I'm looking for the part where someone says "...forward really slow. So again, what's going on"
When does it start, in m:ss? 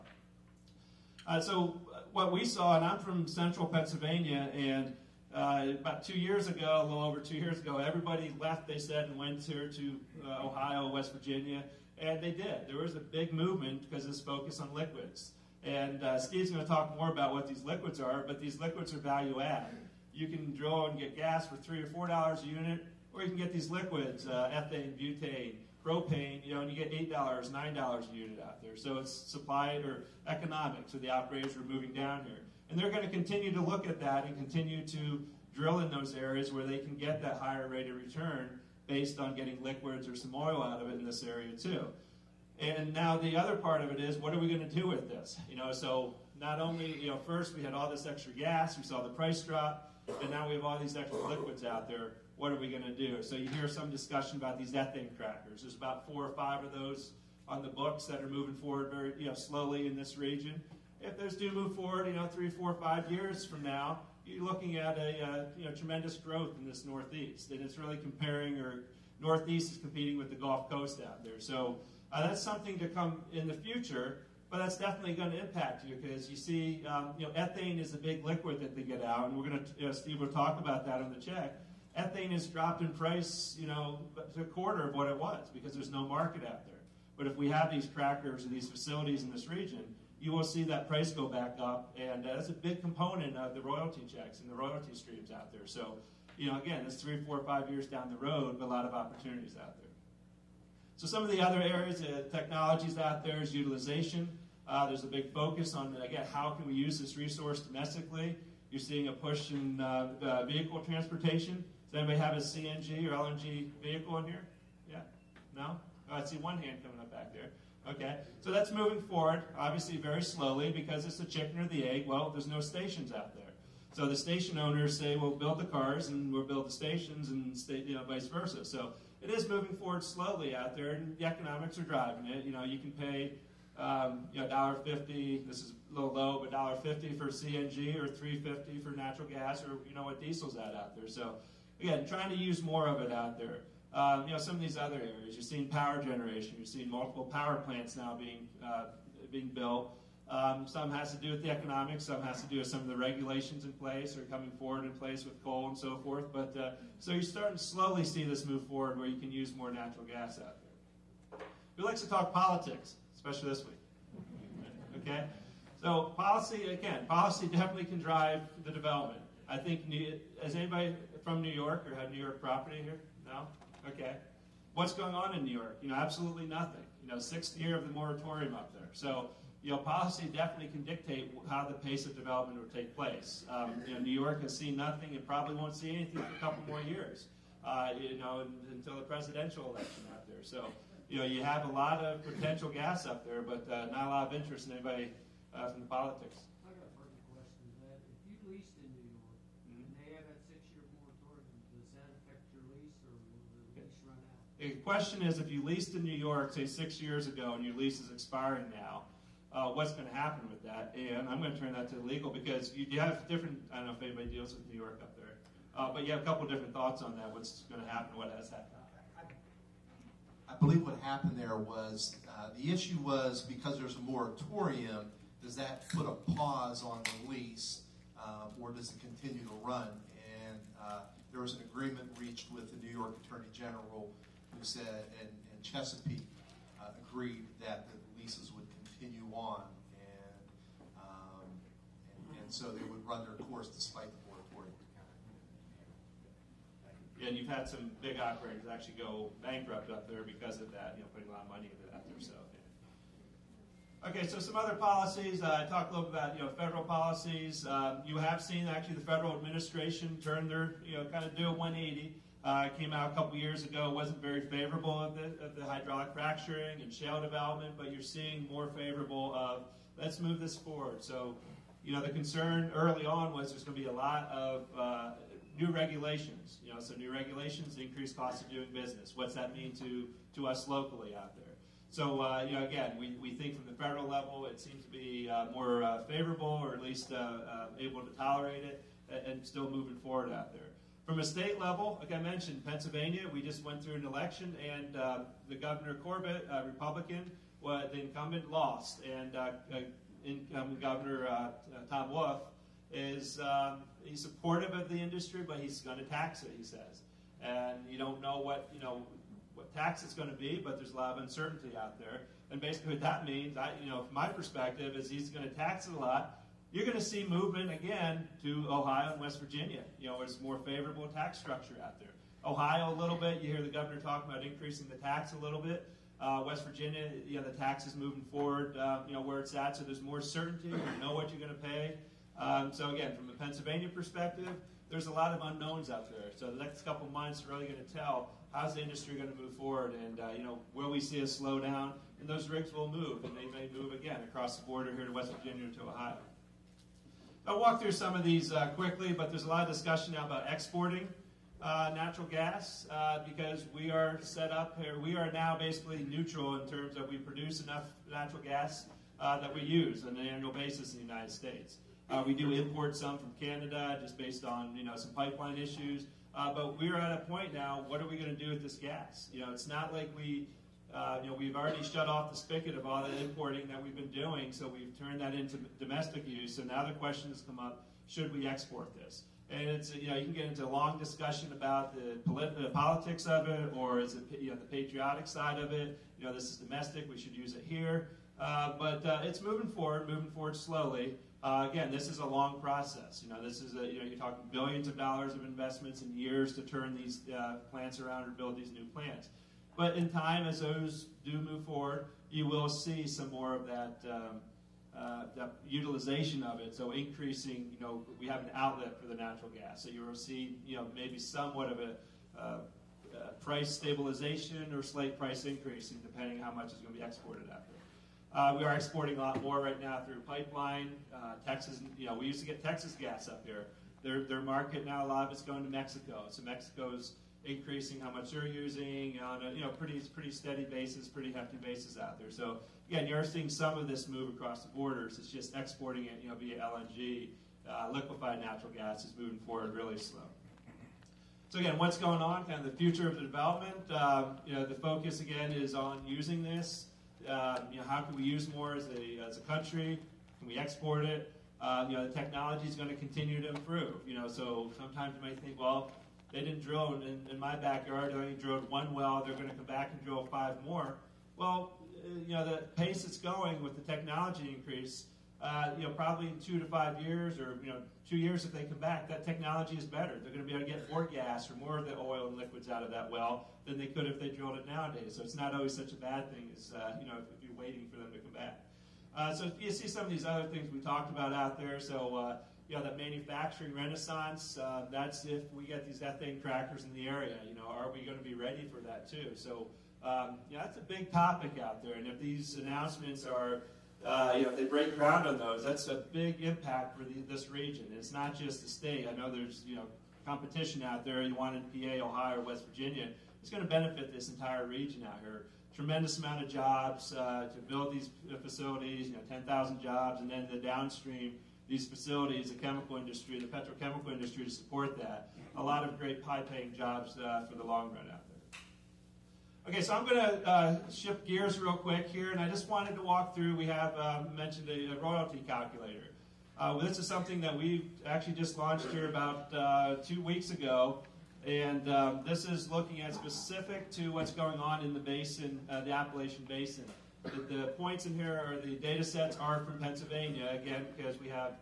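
7:19.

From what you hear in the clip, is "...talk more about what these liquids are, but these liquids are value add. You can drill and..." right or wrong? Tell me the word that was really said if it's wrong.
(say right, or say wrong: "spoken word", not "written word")
right.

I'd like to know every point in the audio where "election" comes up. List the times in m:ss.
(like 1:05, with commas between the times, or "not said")
3:09, 4:54.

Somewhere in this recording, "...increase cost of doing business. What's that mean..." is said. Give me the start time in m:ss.
4:37.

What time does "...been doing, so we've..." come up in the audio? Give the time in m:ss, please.
6:13.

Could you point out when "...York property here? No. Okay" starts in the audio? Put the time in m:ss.
2:52.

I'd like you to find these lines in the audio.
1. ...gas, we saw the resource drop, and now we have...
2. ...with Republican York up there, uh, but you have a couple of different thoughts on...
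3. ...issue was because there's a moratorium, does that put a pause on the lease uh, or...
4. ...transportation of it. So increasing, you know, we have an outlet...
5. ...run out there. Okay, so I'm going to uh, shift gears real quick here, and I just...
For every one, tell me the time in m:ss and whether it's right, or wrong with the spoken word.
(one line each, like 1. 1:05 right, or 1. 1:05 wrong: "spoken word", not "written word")
1. 0:48 wrong: "price", not "resource"
2. 3:34 wrong: "New", not "Republican"
3. 3:42 right
4. 6:45 wrong: "utilization", not "transportation"
5. 8:37 right.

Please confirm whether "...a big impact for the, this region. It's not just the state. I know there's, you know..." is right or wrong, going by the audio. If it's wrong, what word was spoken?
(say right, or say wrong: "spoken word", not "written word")
right.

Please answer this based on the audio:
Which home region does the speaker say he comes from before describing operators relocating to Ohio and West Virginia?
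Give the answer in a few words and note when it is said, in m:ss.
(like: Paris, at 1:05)
central Pennsylvania, at 0:03.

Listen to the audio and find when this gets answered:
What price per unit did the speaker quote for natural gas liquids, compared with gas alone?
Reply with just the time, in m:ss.
0:26.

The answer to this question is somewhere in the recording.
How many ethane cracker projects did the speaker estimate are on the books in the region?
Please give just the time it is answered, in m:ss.
0:56.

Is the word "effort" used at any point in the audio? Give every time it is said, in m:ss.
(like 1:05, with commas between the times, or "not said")
not said.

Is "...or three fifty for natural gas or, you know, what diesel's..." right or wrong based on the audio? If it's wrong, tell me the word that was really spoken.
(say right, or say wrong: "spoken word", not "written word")
right.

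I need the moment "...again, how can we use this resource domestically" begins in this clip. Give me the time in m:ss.
1:45.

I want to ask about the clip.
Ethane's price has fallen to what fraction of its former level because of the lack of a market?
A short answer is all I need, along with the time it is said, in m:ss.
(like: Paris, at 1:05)
a quarter, at 1:24.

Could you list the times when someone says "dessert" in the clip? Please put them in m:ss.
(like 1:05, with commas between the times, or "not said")
not said.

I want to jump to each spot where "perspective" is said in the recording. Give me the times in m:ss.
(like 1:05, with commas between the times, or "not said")
5:14, 5:33.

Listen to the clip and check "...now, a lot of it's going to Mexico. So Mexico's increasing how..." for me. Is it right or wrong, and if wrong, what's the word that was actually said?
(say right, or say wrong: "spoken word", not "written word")
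right.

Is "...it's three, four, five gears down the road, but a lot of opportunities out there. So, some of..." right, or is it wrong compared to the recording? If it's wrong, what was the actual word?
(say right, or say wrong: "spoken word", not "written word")
wrong: "years", not "gears".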